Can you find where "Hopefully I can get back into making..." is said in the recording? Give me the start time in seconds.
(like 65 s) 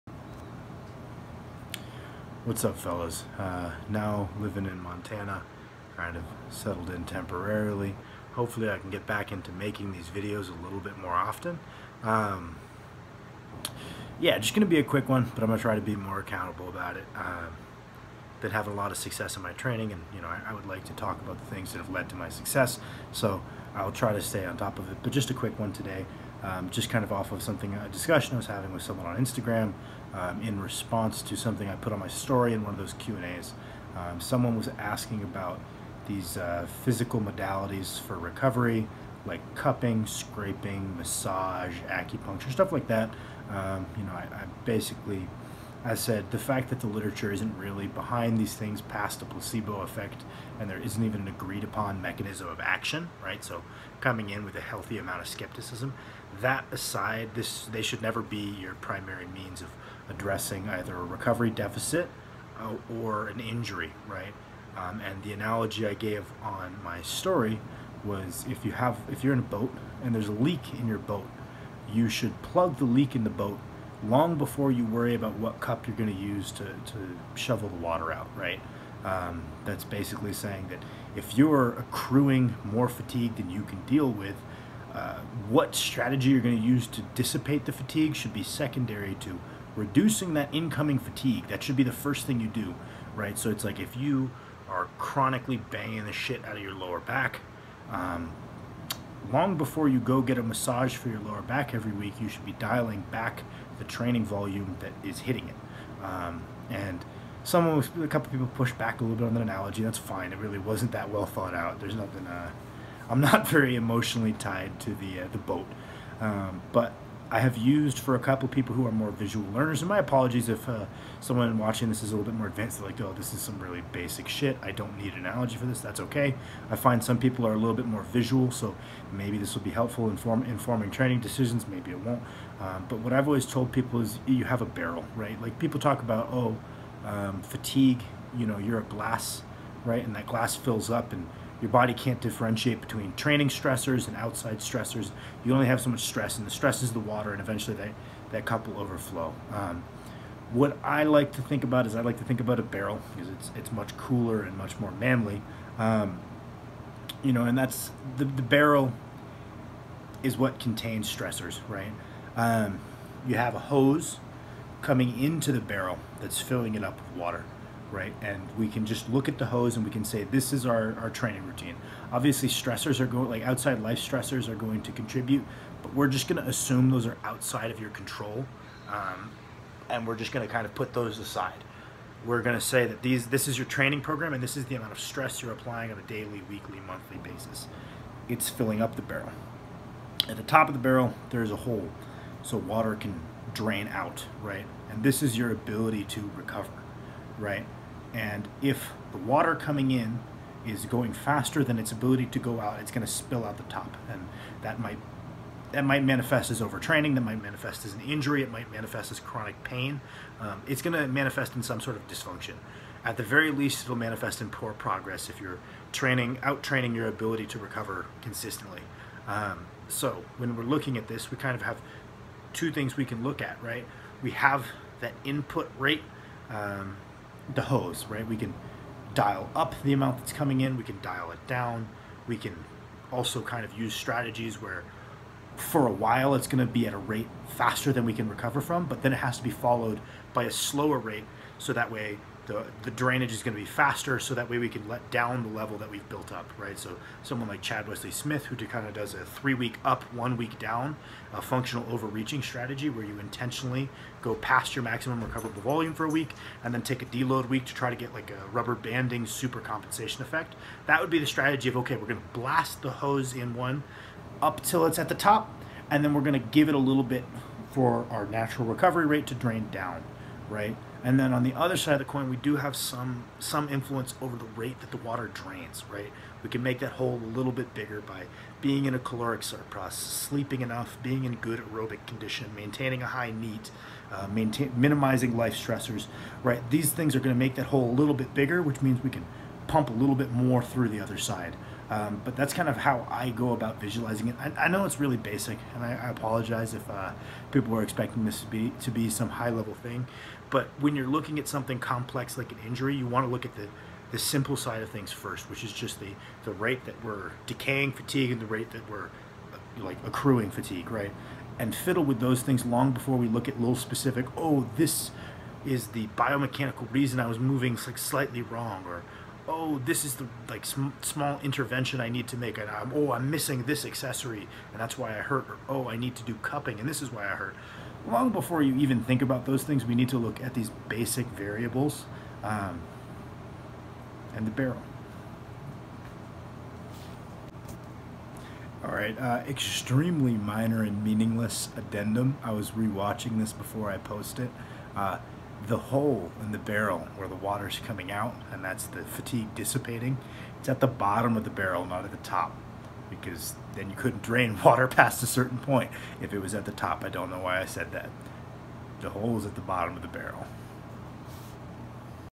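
8 s.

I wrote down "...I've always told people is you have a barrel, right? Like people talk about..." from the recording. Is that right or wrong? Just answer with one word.
right.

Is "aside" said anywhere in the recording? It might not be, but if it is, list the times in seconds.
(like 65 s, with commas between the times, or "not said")
56 s, 181 s.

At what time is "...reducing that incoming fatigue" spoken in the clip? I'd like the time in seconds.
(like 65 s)
89 s.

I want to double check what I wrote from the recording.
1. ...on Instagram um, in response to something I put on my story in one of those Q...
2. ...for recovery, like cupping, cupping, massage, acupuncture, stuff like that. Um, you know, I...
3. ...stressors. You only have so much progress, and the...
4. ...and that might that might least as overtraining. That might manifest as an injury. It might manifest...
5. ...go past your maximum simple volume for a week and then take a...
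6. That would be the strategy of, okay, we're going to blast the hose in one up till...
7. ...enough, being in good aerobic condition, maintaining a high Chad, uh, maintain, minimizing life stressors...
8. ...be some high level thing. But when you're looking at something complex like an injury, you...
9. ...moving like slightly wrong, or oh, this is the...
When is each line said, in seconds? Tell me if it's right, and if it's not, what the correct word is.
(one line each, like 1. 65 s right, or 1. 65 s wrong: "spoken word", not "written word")
1. 29 s right
2. 38 s wrong: "scraping", not "cupping"
3. 144 s wrong: "stress", not "progress"
4. 204 s wrong: "manifest", not "least"
5. 254 s wrong: "recoverable", not "simple"
6. 260 s right
7. 280 s wrong: "NEAT", not "Chad"
8. 298 s right
9. 317 s right.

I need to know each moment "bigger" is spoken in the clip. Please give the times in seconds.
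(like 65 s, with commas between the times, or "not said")
277 s, 288 s.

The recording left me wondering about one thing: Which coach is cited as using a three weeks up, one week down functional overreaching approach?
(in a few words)
Chad Wesley Smith.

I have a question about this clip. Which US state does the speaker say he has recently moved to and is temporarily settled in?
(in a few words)
Montana.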